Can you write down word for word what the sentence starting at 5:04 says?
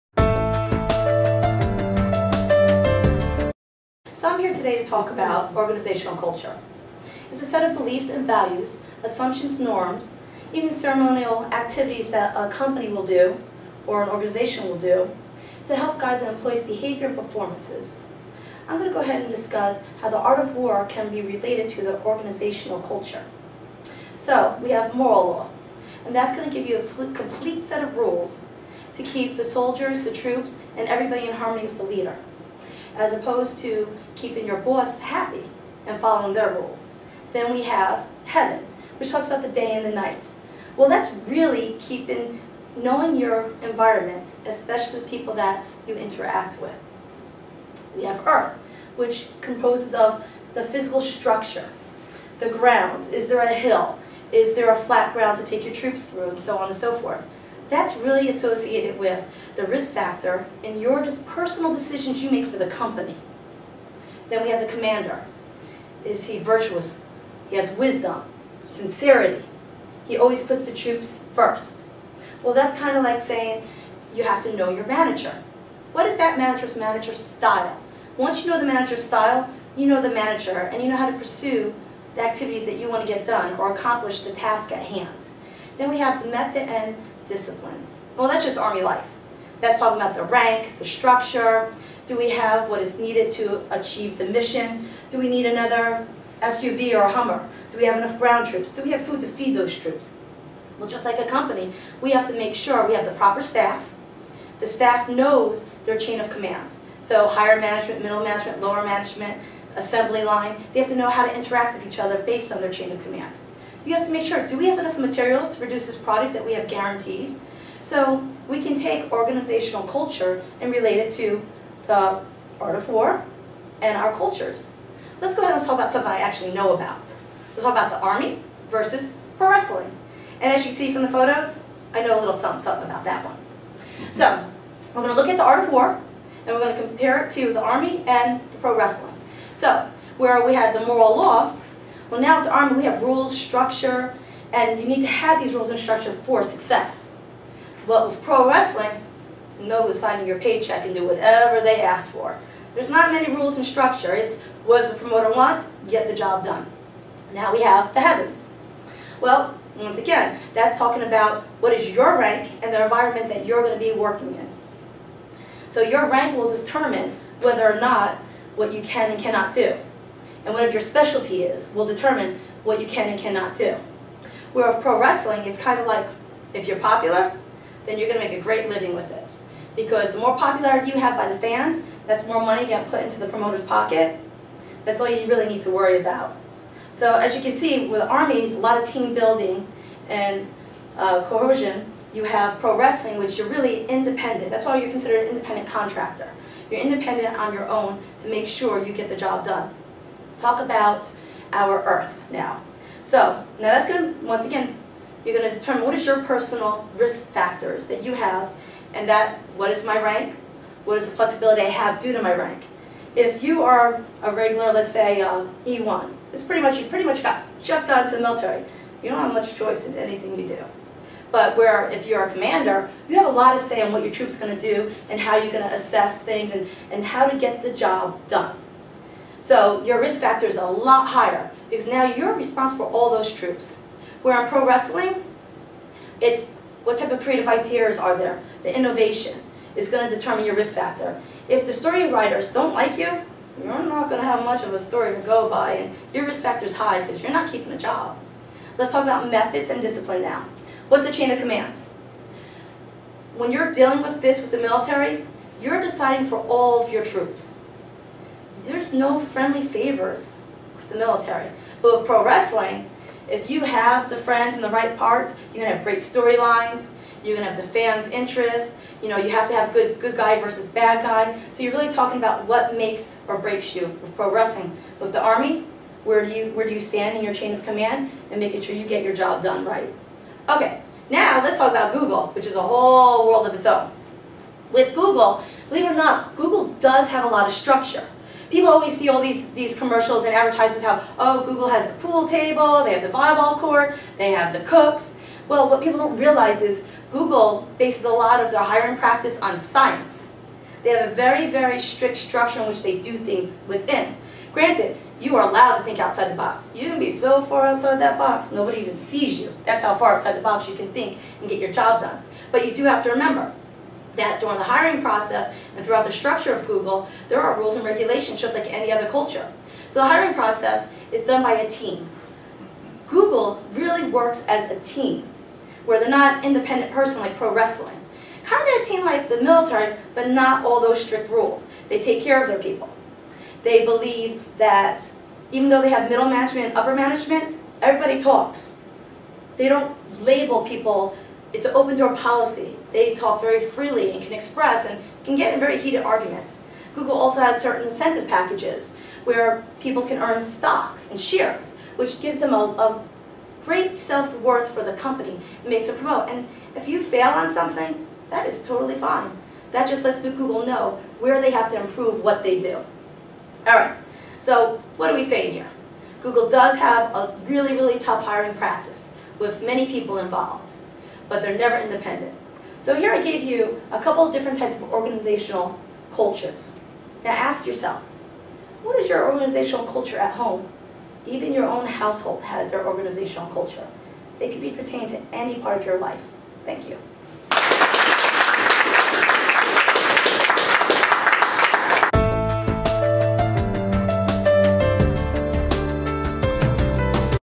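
Granted, you are allowed to think outside the box.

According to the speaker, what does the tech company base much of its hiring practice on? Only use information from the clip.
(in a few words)
Science.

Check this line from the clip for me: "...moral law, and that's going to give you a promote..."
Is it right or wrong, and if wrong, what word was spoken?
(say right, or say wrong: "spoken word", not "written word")
wrong: "complete", not "promote".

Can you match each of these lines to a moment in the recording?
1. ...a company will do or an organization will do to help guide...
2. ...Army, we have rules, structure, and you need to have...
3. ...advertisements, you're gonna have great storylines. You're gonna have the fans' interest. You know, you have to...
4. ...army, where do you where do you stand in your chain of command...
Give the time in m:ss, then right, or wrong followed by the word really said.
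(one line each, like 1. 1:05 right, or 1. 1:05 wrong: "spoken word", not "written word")
1. 0:12 right
2. 2:22 right
3. 4:24 wrong: "parts", not "advertisements"
4. 4:35 right.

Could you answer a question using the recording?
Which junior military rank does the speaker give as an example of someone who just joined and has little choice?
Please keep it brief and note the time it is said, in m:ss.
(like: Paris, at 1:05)
E1, at 3:35.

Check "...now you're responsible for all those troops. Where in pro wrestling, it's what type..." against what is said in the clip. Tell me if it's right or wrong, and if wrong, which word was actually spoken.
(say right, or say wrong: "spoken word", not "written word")
right.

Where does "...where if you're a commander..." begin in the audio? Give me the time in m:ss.
3:41.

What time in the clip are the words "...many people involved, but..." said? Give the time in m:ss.
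6:09.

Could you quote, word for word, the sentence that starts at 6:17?
Now ask yourself, what is your organizational culture at home?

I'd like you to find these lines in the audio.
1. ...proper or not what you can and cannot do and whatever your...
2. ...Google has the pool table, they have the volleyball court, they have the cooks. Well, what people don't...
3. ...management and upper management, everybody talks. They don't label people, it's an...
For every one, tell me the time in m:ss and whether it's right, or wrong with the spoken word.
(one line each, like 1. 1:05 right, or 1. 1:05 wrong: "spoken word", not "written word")
1. 2:47 wrong: "whether", not "proper"
2. 4:51 right
3. 5:36 right.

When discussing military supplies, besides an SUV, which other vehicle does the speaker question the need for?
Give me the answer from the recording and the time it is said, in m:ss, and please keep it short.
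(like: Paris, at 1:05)
Hummer, at 1:37.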